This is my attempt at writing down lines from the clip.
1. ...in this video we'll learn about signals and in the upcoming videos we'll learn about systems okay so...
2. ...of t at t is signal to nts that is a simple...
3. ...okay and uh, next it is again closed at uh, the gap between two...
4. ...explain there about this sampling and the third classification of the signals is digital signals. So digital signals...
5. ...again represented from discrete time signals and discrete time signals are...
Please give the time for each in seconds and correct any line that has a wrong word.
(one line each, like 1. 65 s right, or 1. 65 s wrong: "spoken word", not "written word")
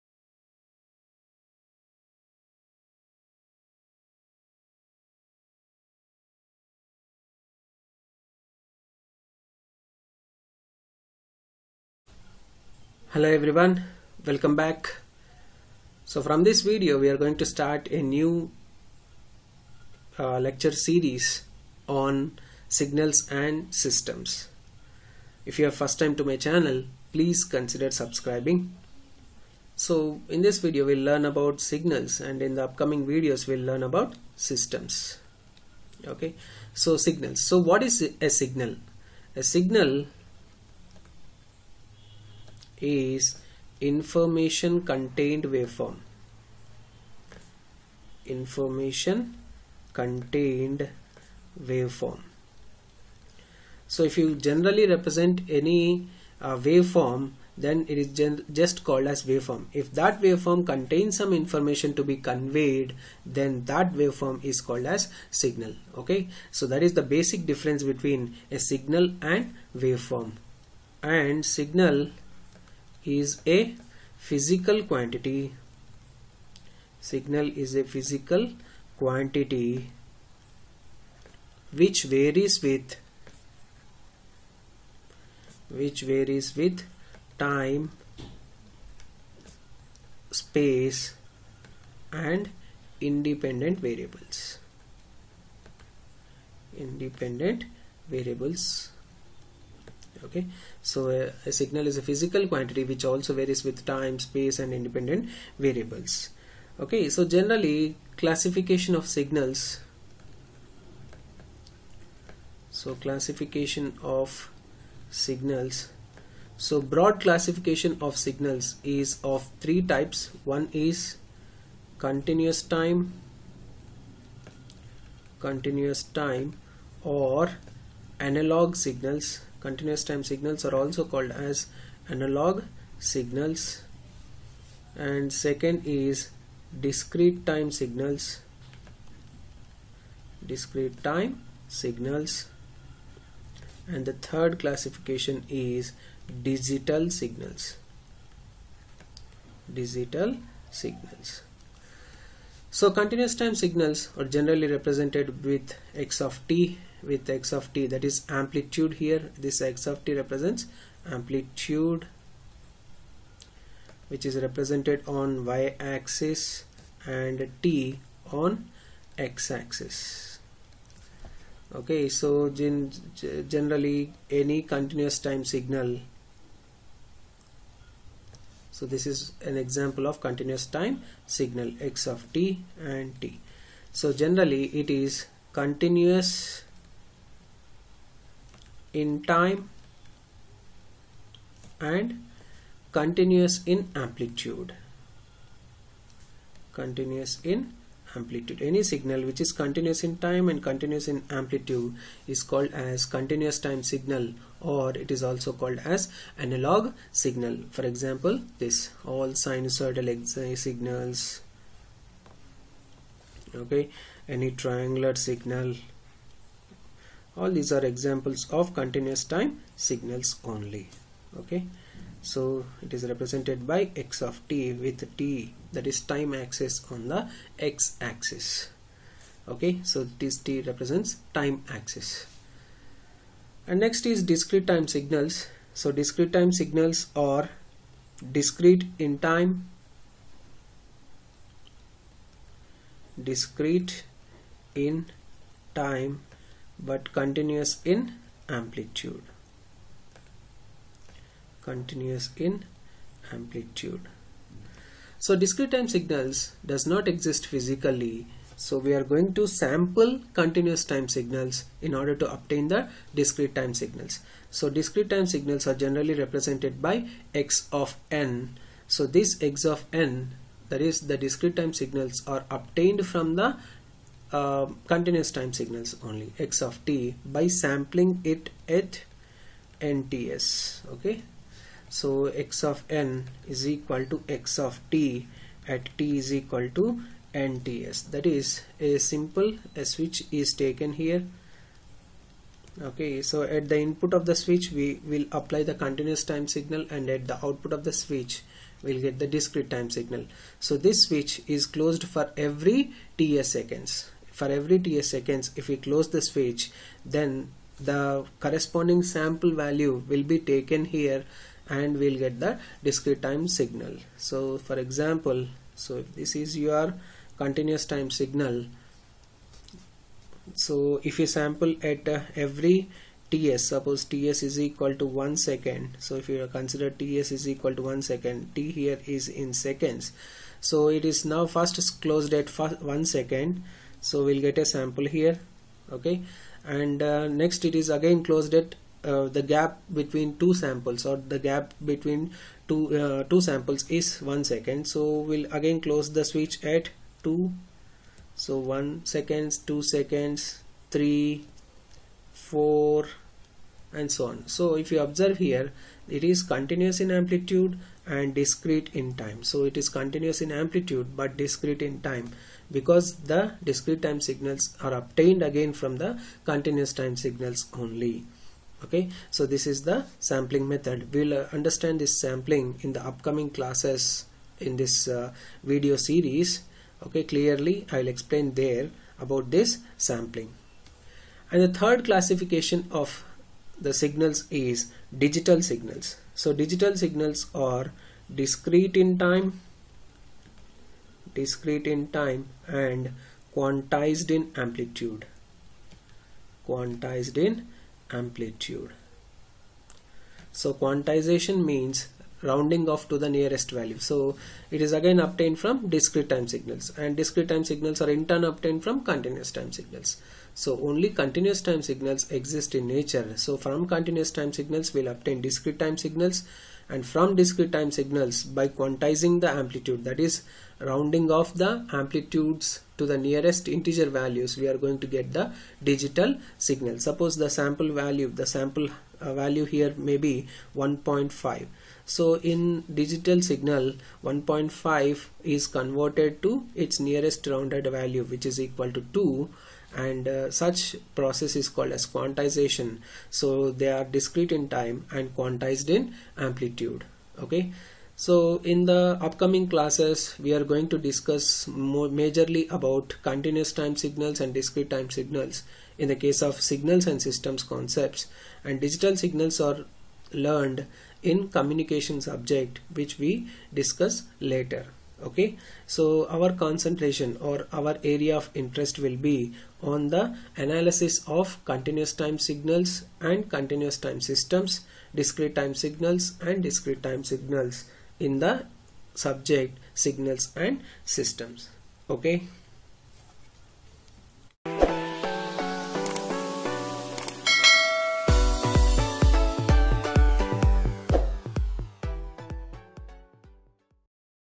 1. 30 s right
2. 284 s wrong: "equal", not "signal"
3. 335 s right
4. 378 s right
5. 404 s wrong: "obtained", not "represented".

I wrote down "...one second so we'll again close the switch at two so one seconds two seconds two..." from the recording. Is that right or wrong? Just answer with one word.
wrong.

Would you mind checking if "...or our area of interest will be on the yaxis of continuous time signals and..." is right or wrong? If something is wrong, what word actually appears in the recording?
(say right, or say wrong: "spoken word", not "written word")
wrong: "analysis", not "yaxis".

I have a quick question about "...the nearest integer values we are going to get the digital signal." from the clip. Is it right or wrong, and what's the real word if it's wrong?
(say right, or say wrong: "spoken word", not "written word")
right.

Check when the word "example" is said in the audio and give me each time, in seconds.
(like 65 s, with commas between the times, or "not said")
179 s, 207 s, 217 s, 314 s.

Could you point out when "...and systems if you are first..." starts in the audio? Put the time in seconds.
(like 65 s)
23 s.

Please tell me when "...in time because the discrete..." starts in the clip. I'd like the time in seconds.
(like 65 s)
361 s.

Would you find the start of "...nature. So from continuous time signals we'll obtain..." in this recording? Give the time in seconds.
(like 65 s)
412 s.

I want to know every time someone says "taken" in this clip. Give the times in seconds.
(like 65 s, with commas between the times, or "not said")
290 s, 310 s.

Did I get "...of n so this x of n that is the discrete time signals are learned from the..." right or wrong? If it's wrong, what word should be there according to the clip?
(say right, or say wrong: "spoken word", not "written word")
wrong: "obtained", not "learned".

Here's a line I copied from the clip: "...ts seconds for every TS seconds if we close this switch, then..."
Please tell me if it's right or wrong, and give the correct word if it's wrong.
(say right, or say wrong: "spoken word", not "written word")
right.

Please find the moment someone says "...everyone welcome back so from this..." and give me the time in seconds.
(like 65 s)
13 s.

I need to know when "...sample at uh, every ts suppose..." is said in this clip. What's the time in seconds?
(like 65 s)
321 s.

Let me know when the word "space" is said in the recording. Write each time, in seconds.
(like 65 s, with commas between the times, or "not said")
90 s, 104 s.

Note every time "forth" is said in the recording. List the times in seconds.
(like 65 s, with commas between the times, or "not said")
not said.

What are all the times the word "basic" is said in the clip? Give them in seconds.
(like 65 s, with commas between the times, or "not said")
67 s.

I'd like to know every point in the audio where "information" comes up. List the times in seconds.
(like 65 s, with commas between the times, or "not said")
43 s, 48 s, 61 s.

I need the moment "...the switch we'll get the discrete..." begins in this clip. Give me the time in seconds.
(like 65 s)
297 s.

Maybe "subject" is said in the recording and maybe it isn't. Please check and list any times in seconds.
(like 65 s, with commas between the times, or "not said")
462 s, 479 s.